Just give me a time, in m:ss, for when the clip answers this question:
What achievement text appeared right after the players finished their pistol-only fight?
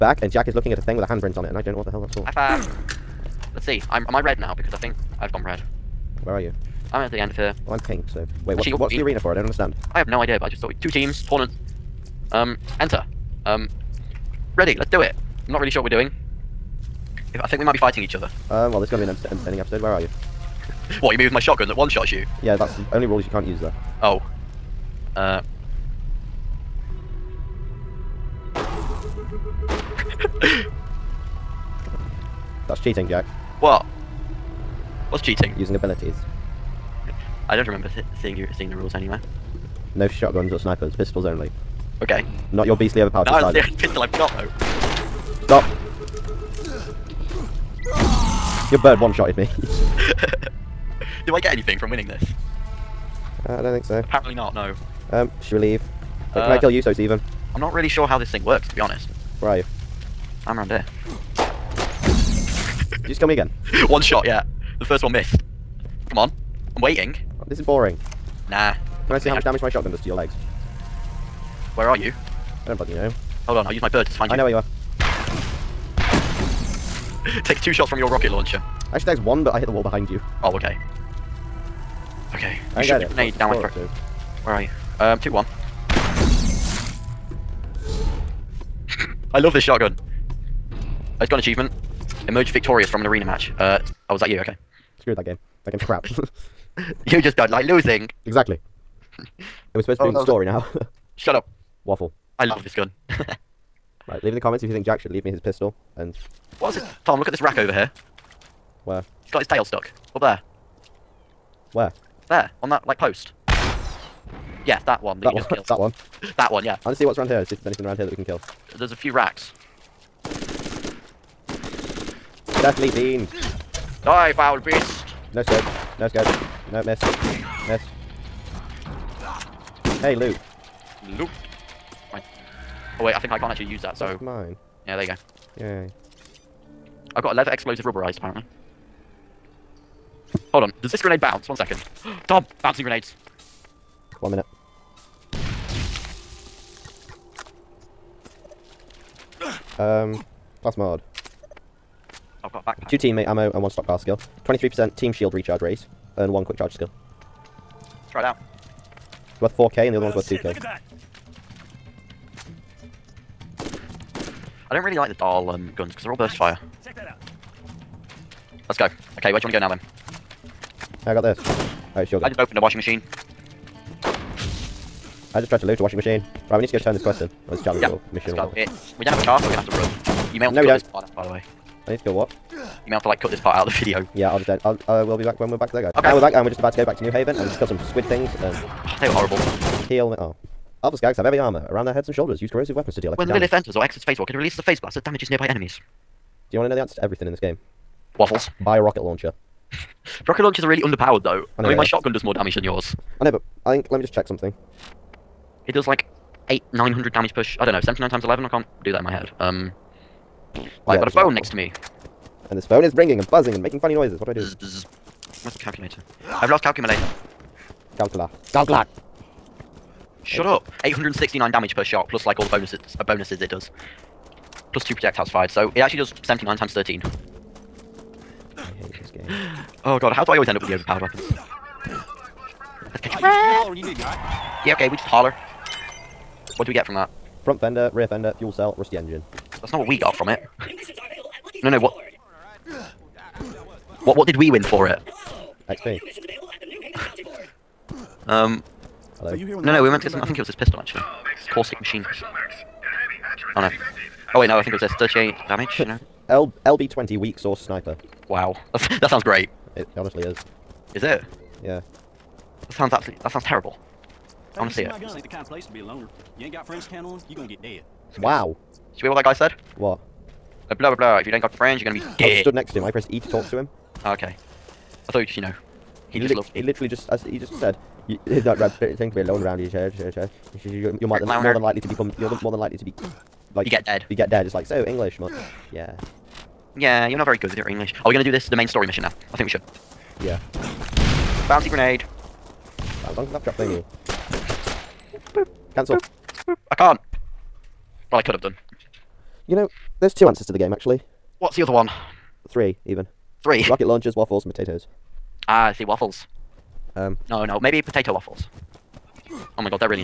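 1:32.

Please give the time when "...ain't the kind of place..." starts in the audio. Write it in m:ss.
4:25.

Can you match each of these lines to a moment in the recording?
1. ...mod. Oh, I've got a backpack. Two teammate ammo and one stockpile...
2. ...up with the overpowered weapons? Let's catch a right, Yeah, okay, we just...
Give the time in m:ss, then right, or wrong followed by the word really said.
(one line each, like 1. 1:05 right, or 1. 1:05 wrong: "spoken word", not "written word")
1. 2:30 right
2. 3:50 right.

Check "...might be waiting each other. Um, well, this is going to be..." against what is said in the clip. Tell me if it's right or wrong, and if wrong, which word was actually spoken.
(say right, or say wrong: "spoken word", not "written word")
wrong: "fighting", not "waiting".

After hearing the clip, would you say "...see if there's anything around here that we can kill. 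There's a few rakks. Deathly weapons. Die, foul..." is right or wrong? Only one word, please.
wrong.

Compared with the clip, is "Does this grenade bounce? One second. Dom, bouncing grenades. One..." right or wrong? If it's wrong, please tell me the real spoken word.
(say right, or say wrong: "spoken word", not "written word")
right.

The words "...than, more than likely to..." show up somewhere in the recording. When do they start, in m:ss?
4:41.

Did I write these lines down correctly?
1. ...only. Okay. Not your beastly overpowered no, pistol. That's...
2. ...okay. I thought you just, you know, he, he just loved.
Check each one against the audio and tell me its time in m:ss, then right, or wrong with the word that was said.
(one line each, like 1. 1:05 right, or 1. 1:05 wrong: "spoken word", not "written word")
1. 0:41 right
2. 4:34 right.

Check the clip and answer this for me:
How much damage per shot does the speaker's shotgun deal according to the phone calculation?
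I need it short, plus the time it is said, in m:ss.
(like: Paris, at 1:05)
869, at 3:40.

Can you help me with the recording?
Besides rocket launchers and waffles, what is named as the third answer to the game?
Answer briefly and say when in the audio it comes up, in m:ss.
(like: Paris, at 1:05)
potatoes, at 5:04.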